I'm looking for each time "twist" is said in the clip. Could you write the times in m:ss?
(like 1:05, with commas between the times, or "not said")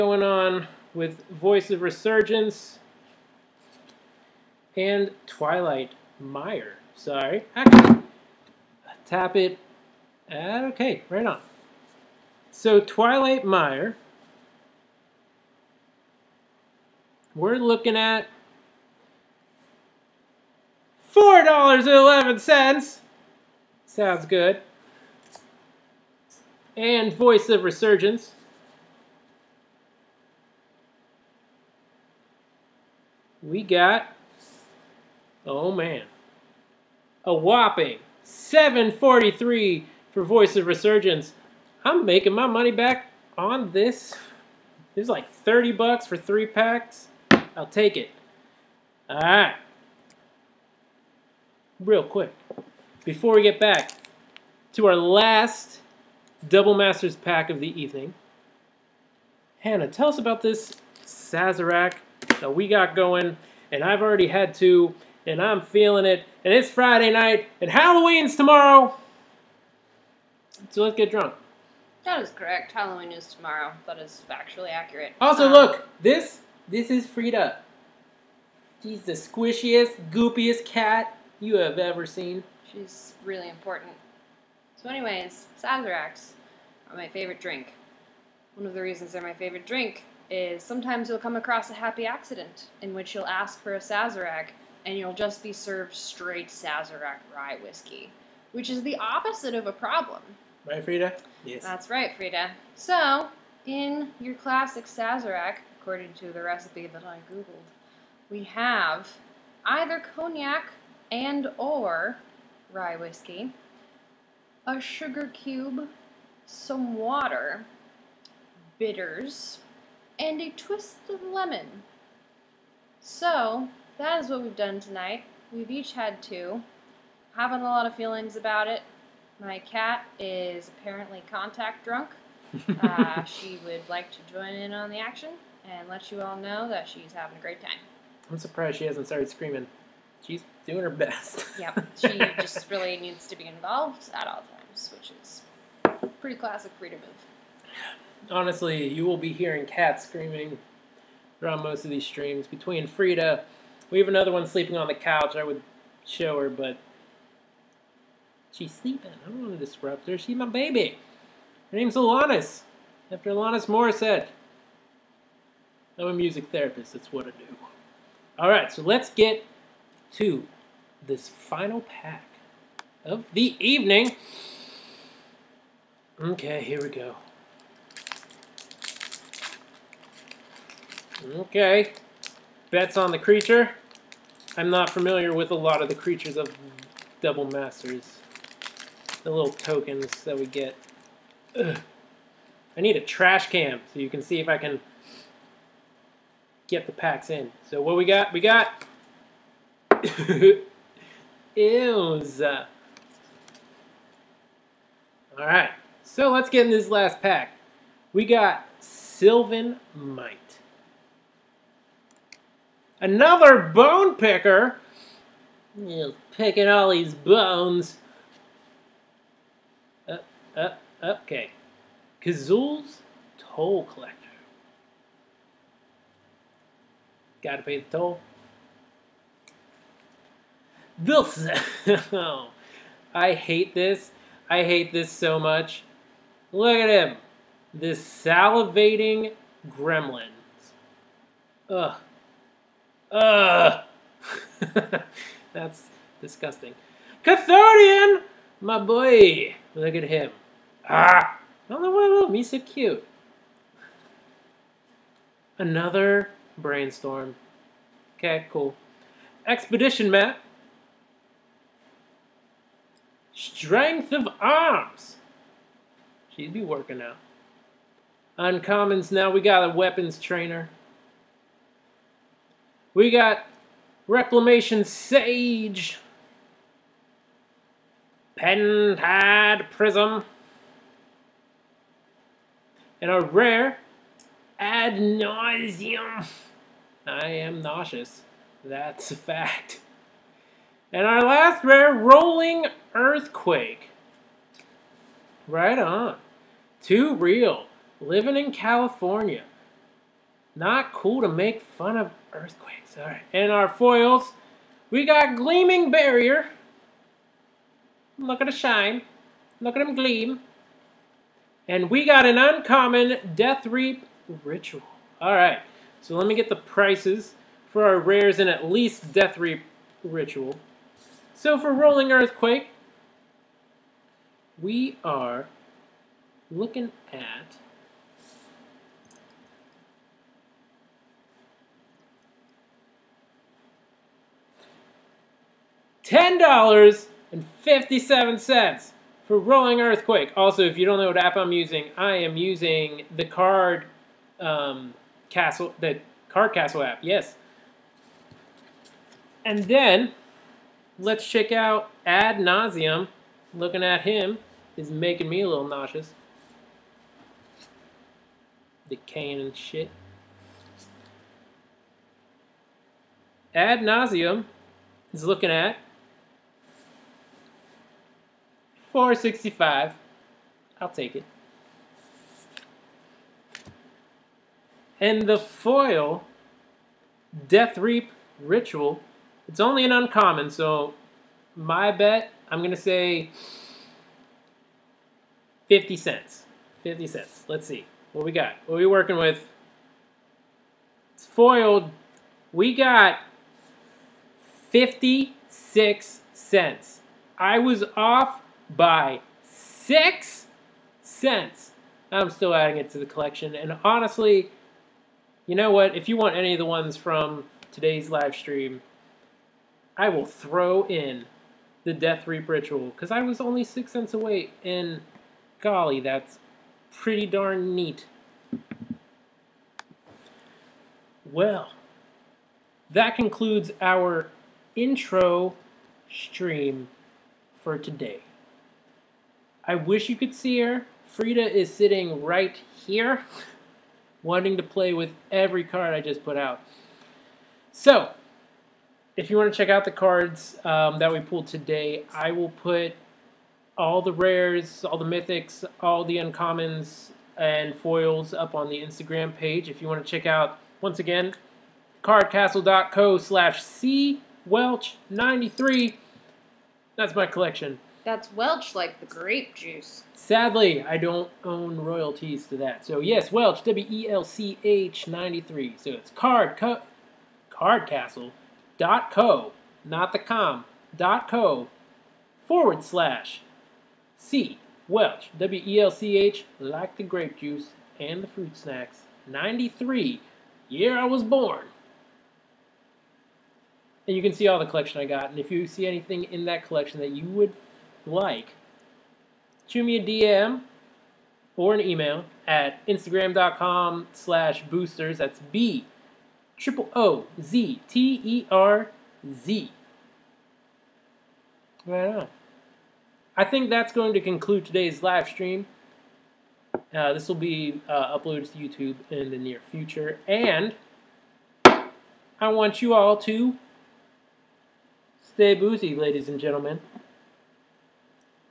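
2:00.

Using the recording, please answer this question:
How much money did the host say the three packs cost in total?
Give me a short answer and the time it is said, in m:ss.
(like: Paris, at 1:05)
$30, at 0:45.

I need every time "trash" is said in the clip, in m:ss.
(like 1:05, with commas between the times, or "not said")
3:13.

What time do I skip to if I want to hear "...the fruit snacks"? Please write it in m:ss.
7:58.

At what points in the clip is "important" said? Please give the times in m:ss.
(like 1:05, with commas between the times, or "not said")
1:23.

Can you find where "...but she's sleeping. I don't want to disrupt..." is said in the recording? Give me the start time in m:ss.
2:36.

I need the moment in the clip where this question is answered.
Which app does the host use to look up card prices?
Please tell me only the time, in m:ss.
5:46.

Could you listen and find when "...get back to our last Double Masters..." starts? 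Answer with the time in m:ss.
0:53.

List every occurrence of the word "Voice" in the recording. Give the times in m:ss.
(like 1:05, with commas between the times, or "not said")
0:01, 0:27, 0:40.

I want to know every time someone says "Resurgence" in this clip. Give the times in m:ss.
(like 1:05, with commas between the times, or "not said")
0:01, 0:27, 0:40.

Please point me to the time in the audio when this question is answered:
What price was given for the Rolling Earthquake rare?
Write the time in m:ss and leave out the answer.
5:36.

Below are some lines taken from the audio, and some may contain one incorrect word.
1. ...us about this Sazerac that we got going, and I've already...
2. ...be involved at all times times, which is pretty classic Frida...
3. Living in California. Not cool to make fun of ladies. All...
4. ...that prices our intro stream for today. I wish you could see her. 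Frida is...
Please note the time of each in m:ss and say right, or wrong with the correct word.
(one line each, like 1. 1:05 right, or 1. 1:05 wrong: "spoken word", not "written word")
1. 1:00 right
2. 2:23 right
3. 4:58 wrong: "earthquakes", not "ladies"
4. 7:02 wrong: "concludes", not "prices".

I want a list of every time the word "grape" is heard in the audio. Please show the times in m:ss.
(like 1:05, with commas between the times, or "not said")
7:39, 7:57.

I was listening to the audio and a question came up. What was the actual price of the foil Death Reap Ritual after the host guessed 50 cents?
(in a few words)
56 cents.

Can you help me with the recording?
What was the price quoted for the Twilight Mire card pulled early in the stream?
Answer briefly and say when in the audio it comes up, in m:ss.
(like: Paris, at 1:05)
$4.11, at 0:21.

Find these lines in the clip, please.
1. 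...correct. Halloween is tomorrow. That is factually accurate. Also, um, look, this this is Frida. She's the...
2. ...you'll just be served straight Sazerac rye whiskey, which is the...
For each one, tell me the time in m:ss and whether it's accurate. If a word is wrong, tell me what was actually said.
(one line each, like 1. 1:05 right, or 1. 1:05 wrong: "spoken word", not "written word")
1. 1:12 right
2. 1:34 right.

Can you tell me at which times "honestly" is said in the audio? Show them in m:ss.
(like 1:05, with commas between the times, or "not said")
2:28, 6:43.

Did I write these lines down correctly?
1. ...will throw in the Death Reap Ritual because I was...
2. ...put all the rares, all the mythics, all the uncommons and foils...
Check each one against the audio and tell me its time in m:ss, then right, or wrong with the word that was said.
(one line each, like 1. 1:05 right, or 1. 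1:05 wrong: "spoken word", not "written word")
1. 6:50 right
2. 7:22 right.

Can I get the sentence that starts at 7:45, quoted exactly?
So it's card, co, cardcastle.co, not the com, dot co, forward slash C.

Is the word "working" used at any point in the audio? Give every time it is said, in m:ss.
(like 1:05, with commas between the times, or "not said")
4:26, 6:28.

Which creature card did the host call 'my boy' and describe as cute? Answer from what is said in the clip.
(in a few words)
Cathodion.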